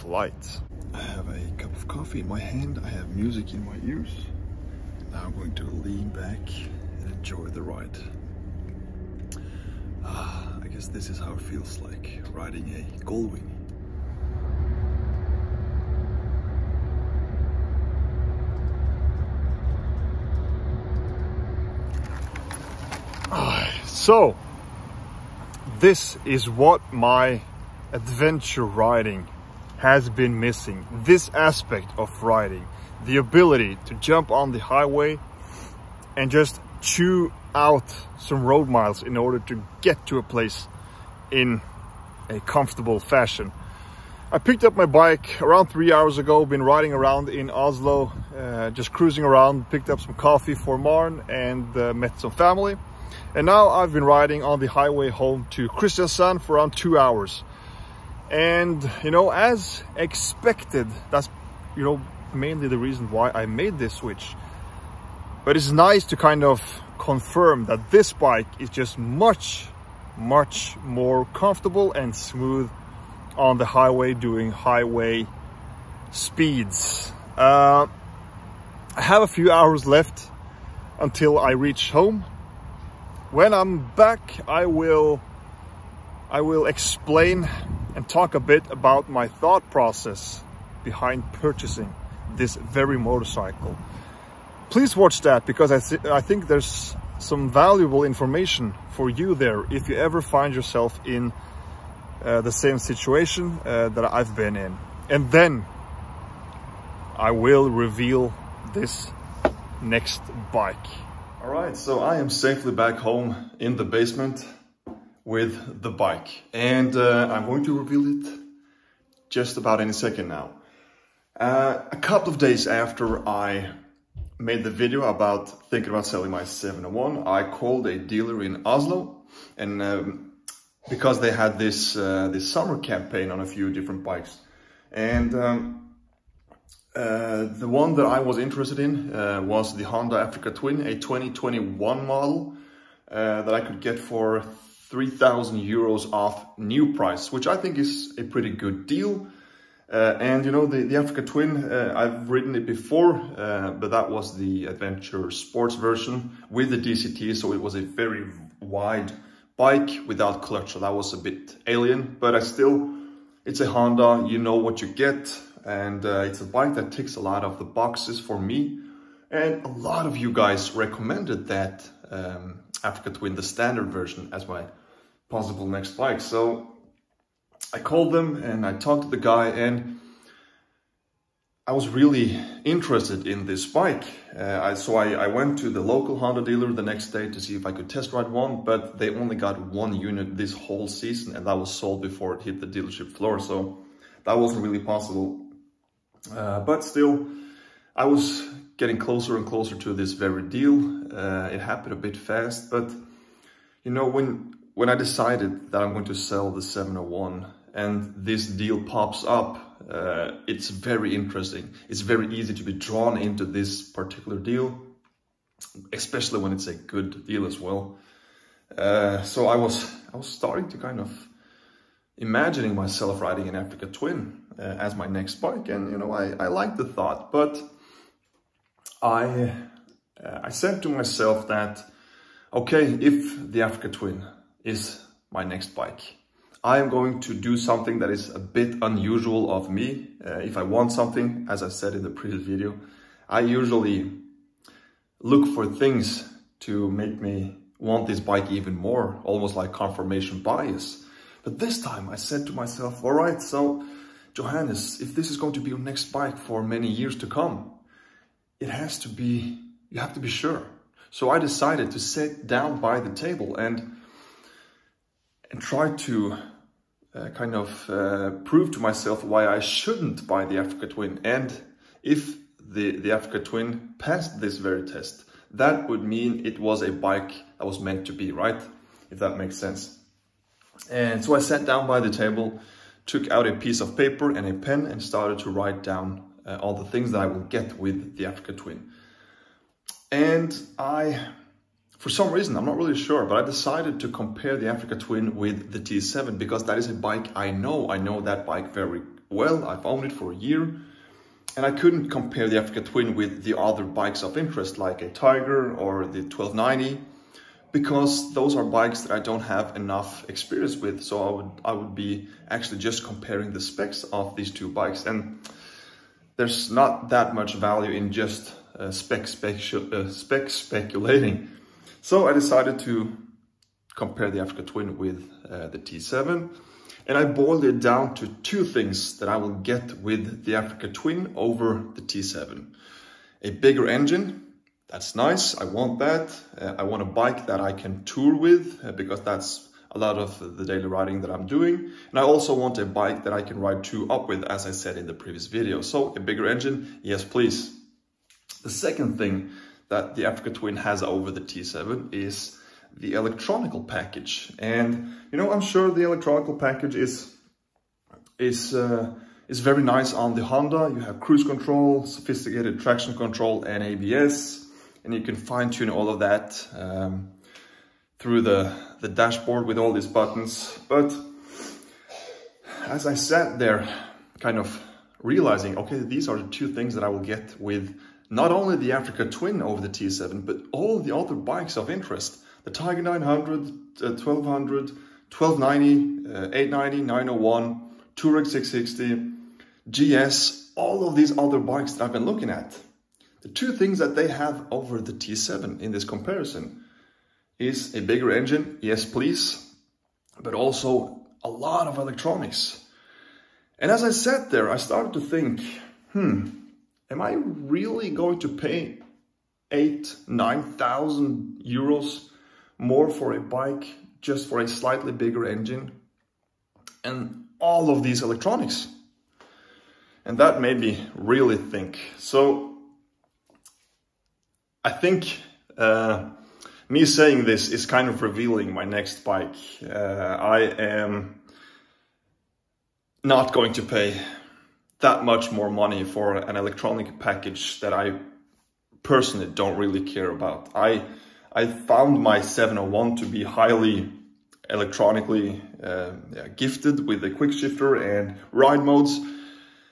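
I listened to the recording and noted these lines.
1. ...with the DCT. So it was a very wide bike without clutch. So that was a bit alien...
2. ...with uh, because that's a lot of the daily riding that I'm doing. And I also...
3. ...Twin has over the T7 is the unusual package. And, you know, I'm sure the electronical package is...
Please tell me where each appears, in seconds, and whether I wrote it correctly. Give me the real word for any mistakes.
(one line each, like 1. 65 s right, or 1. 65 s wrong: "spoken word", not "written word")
1. 156 s right
2. 338 s right
3. 350 s wrong: "electronical", not "unusual".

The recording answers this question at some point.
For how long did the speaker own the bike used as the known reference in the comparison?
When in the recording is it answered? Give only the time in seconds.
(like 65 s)
300 s.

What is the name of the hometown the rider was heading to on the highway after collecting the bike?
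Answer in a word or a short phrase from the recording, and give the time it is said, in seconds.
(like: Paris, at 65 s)
Kristiansand, at 55 s.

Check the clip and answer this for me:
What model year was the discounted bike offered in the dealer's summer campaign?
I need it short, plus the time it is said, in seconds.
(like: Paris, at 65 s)
2021, at 140 s.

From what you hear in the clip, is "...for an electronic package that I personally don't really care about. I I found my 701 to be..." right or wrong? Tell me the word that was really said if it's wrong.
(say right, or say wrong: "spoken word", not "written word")
right.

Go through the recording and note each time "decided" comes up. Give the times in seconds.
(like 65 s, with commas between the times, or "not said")
204 s, 261 s, 293 s, 322 s.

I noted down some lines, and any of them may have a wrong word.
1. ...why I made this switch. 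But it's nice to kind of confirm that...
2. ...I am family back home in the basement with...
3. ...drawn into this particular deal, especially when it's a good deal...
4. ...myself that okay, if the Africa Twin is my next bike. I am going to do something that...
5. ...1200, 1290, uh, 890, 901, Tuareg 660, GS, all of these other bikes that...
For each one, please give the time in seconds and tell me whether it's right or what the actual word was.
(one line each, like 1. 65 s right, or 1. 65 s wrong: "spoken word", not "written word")
1. 63 s right
2. 111 s wrong: "safely", not "family"
3. 212 s right
4. 230 s right
5. 384 s right.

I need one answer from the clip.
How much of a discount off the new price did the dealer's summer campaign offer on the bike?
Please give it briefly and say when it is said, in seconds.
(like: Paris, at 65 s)
3,000 euros, at 144 s.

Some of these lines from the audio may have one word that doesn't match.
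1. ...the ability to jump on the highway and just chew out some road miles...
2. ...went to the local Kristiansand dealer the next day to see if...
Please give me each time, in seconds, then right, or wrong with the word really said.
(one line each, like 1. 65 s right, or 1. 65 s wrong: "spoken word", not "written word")
1. 33 s right
2. 185 s wrong: "Honda", not "Kristiansand".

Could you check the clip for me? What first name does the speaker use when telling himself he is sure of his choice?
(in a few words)
Johannes.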